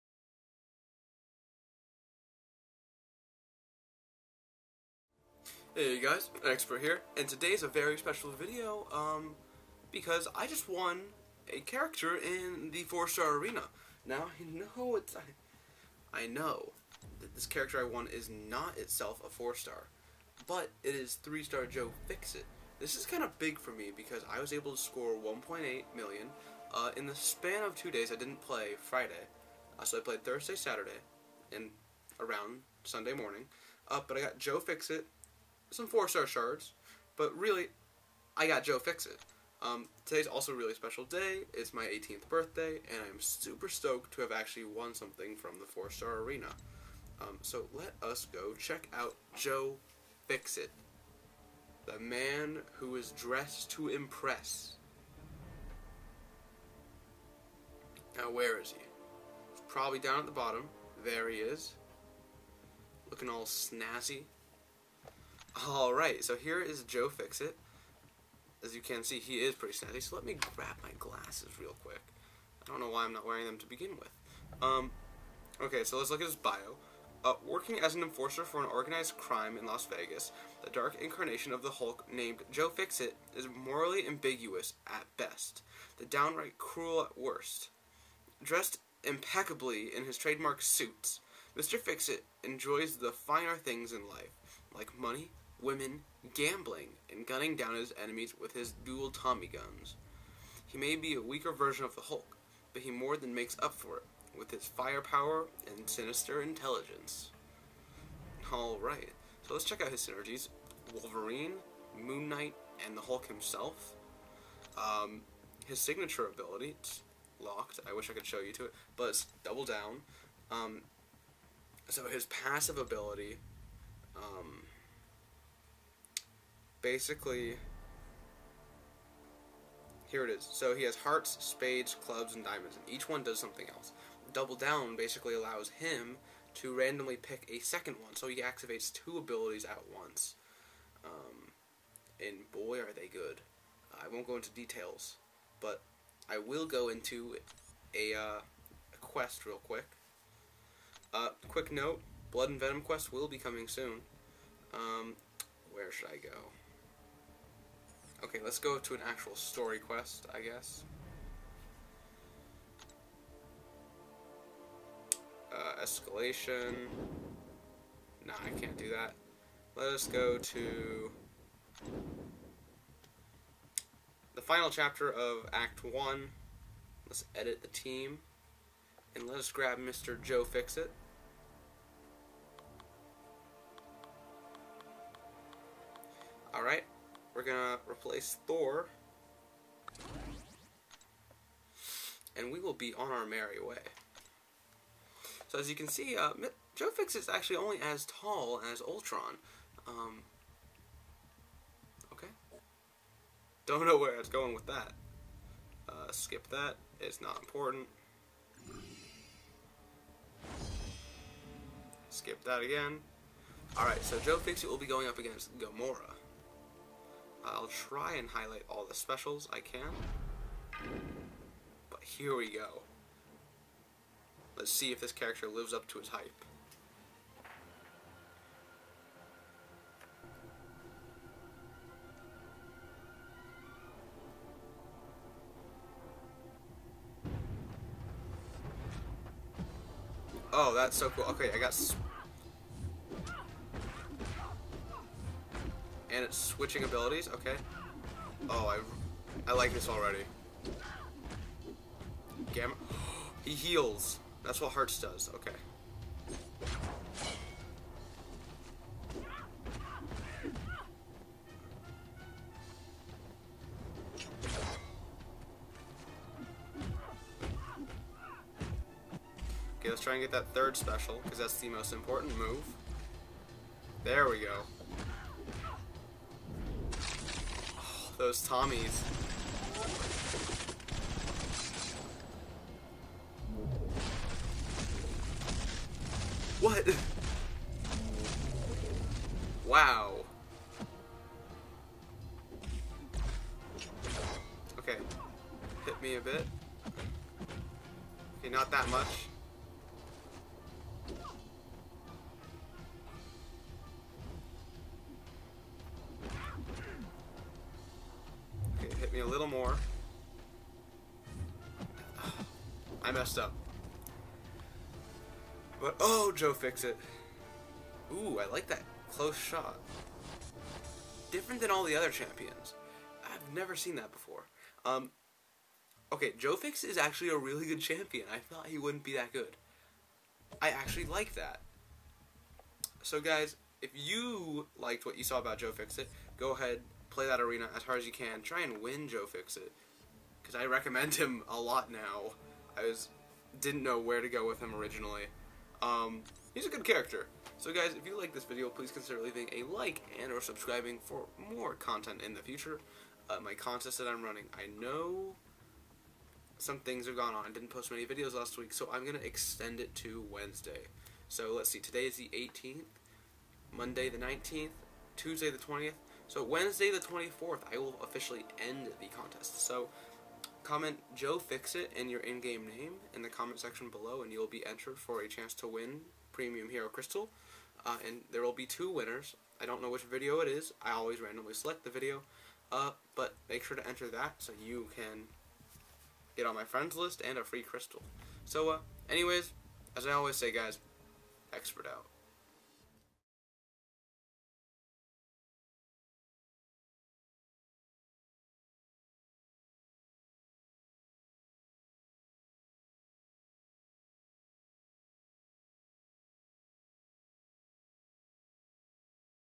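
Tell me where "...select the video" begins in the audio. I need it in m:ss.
6:21.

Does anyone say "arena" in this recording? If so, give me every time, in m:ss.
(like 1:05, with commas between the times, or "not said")
0:13, 0:46, 5:37.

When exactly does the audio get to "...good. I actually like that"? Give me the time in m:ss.
5:29.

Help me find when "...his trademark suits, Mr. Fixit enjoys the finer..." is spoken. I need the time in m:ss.
1:30.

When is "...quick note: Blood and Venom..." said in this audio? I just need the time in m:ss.
2:31.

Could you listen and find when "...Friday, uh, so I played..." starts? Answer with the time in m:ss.
0:28.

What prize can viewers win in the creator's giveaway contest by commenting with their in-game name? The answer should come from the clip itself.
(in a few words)
Premium Hero Crystal.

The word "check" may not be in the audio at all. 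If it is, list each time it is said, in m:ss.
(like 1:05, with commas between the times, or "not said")
0:48, 1:49.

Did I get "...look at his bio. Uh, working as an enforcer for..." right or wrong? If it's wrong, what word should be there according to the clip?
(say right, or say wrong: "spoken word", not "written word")
right.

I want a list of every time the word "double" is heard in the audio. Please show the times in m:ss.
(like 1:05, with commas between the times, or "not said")
1:59, 2:14.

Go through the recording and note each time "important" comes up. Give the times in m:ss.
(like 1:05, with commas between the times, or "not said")
3:27, 4:31.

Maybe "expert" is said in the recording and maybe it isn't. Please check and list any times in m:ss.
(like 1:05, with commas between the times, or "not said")
0:06, 6:31.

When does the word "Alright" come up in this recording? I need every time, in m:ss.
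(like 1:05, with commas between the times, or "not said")
1:48, 3:33.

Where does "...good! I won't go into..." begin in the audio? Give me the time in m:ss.
2:23.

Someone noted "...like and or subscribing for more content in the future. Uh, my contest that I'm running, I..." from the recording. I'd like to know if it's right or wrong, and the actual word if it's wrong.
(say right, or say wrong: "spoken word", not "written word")
right.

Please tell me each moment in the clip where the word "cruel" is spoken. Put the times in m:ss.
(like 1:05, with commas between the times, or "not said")
1:26.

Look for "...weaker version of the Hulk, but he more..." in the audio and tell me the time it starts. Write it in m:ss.
1:41.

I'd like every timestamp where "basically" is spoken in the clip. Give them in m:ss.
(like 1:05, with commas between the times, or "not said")
2:06, 2:14.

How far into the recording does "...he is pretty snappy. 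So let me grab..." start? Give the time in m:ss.
1:09.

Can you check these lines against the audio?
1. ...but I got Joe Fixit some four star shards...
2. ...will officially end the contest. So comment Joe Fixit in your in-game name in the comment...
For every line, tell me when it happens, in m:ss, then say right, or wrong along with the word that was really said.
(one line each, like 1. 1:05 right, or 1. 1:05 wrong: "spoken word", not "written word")
1. 0:34 right
2. 6:07 right.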